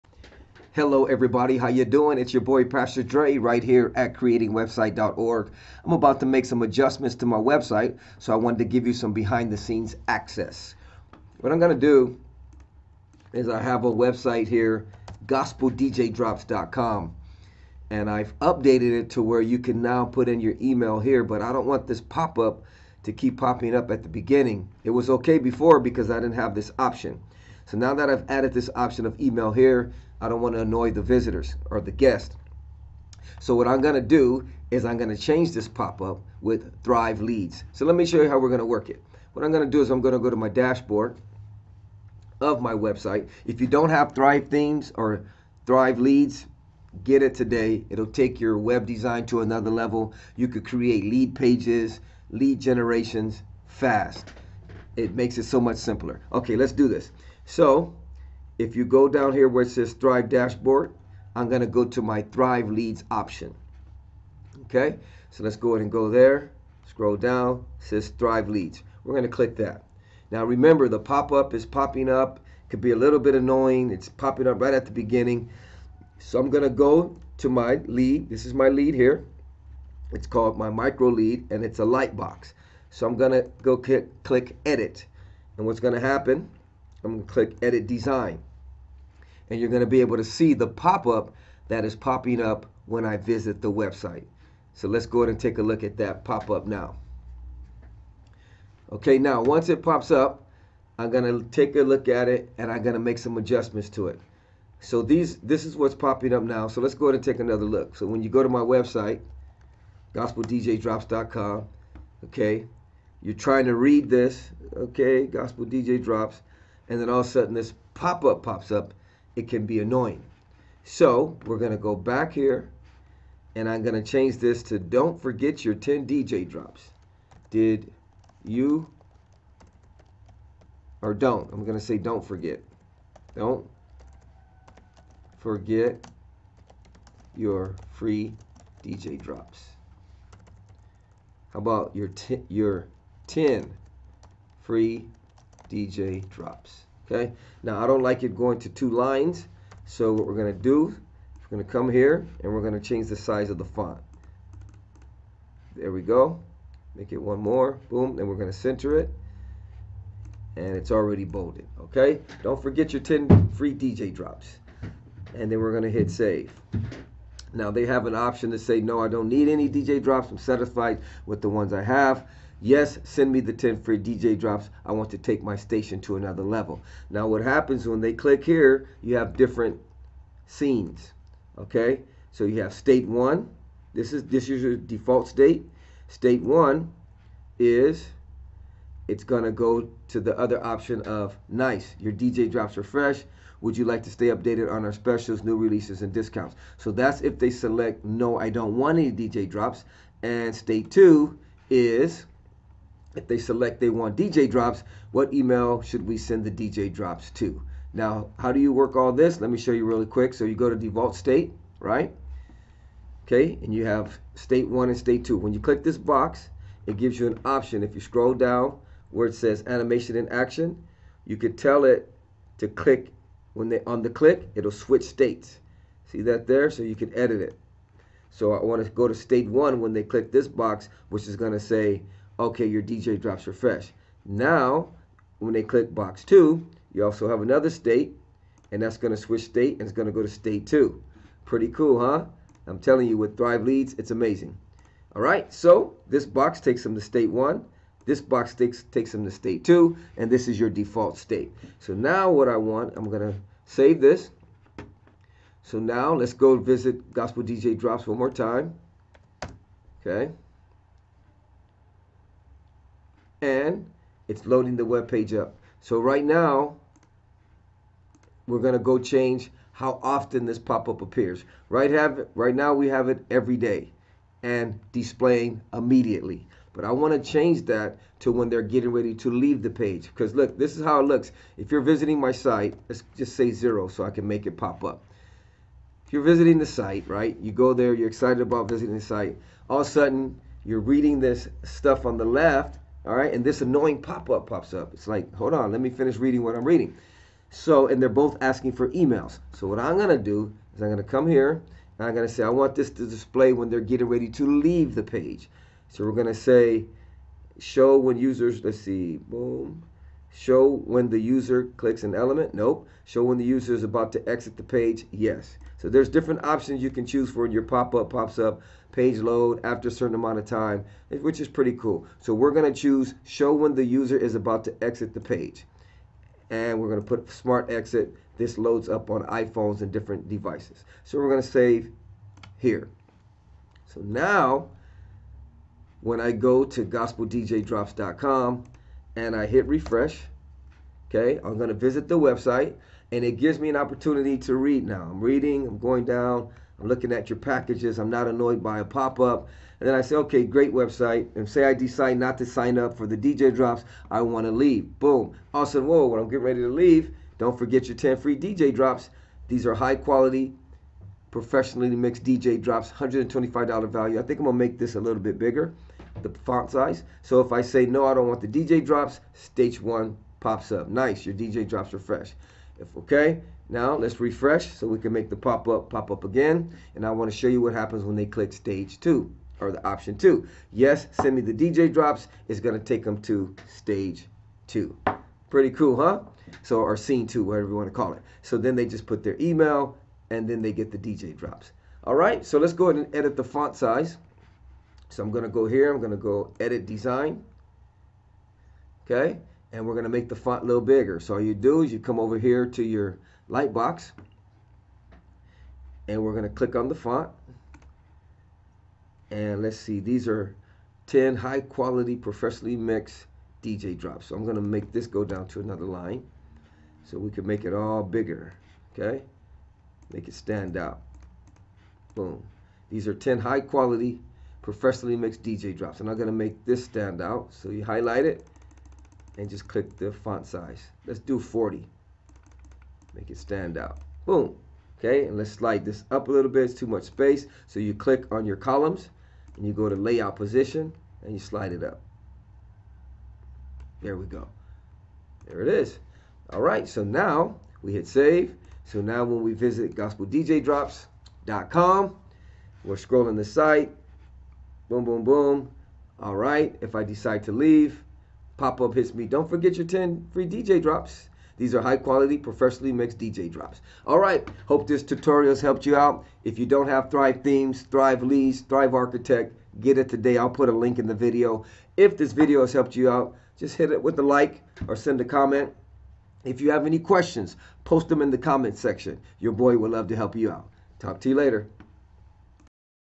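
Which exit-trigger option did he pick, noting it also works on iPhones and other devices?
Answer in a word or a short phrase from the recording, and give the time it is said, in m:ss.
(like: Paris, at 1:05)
smart exit, at 5:27.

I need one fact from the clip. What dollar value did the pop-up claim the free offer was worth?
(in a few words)
$125.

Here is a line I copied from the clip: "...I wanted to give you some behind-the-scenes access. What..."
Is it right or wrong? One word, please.
right.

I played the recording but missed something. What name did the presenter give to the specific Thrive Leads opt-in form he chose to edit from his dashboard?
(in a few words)
micro lead.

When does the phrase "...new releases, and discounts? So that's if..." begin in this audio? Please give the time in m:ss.
3:15.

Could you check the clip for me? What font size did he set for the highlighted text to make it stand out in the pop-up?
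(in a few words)
40.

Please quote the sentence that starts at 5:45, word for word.
I'm reading, I'm going down, I'm looking at your packages, I'm not annoyed by a pop up.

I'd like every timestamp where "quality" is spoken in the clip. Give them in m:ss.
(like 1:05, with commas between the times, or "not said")
5:59, 6:51, 7:03, 7:41.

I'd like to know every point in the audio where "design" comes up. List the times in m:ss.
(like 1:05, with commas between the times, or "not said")
0:48, 1:27, 6:36.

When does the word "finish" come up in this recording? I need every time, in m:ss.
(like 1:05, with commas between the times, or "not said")
4:55.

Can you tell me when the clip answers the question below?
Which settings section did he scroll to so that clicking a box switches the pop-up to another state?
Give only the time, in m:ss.
3:39.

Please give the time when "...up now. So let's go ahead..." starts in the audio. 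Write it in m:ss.
1:46.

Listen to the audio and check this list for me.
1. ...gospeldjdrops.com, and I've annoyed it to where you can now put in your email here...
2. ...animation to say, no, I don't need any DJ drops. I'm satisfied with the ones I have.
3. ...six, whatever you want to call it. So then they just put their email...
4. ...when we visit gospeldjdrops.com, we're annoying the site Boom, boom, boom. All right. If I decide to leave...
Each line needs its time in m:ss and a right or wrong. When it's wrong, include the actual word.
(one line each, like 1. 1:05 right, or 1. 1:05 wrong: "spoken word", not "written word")
1. 0:15 wrong: "updated", not "annoyed"
2. 2:48 wrong: "option", not "animation"
3. 6:27 wrong: "two", not "six"
4. 7:29 wrong: "scrolling", not "annoying".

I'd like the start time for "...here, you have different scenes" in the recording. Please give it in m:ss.
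2:58.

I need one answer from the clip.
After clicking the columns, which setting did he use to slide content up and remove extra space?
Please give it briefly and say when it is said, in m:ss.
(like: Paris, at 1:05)
layout position, at 7:19.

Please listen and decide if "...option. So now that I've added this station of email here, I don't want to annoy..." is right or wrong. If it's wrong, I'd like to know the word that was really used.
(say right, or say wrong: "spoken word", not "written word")
wrong: "option", not "station".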